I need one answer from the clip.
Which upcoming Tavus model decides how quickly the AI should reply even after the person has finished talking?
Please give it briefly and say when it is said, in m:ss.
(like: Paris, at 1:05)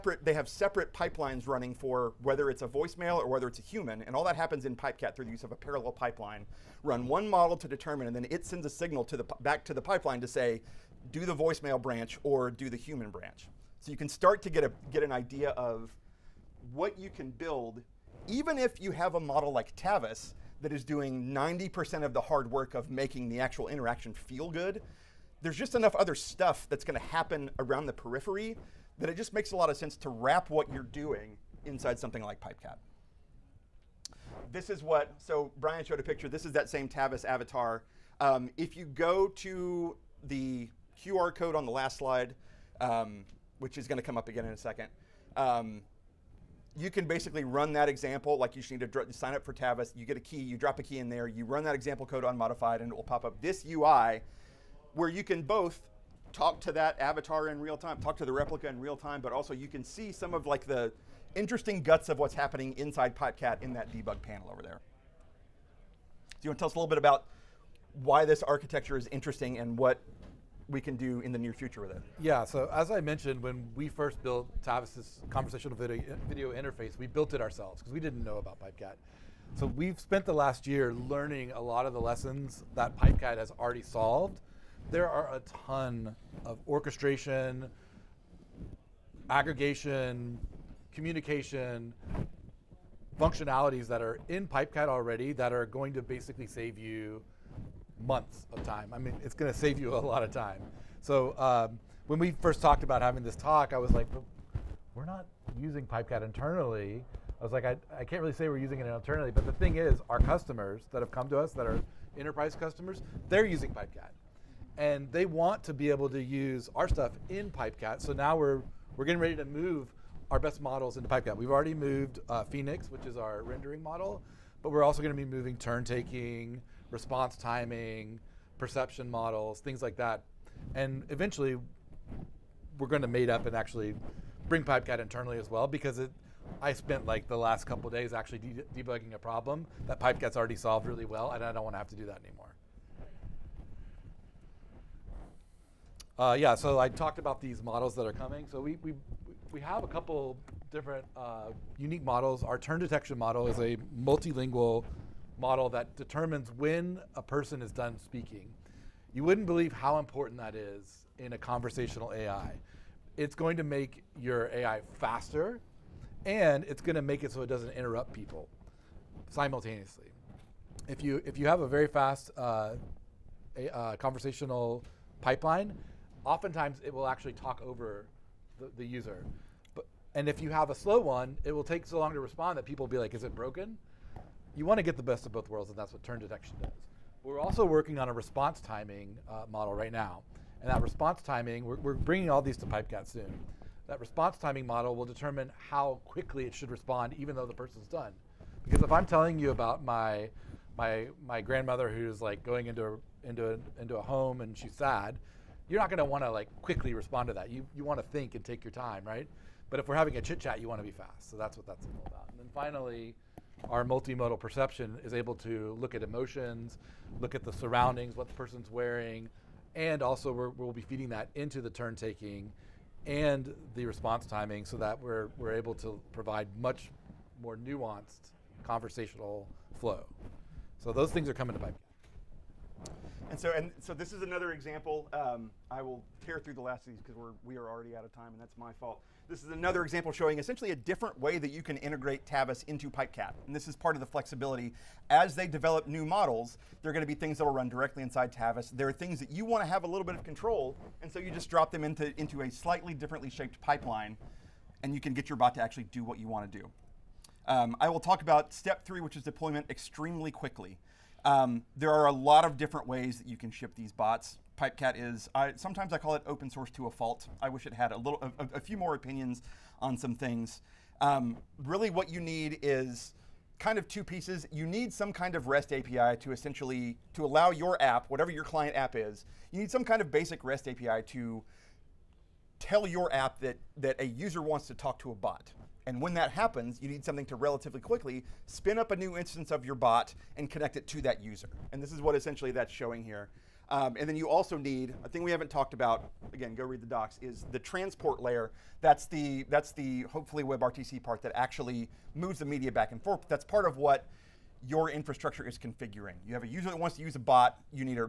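response timing model, at 3:13.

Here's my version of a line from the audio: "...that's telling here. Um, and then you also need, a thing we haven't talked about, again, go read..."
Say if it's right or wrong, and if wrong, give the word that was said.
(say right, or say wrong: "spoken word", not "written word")
wrong: "showing", not "telling".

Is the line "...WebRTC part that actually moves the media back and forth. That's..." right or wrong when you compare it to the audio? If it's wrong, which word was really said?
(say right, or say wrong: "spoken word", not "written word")
right.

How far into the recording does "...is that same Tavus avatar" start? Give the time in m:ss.
0:36.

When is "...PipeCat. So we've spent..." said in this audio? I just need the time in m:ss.
1:18.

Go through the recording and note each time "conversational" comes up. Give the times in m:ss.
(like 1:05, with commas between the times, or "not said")
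1:15, 2:41, 2:53, 3:48.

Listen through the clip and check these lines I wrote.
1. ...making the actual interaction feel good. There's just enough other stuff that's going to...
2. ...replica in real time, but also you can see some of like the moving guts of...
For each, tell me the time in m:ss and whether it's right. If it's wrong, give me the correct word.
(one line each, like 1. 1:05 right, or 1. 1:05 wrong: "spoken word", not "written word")
1. 0:22 right
2. 0:58 wrong: "interesting", not "moving".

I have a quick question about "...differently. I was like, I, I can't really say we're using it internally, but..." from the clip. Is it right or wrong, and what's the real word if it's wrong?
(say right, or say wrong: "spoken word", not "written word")
wrong: "internally", not "differently".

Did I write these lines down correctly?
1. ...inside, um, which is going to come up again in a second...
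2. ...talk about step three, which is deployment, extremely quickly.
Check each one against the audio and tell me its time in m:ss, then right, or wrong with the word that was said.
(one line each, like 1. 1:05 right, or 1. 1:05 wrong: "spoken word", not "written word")
1. 0:41 wrong: "slide", not "inside"
2. 4:17 right.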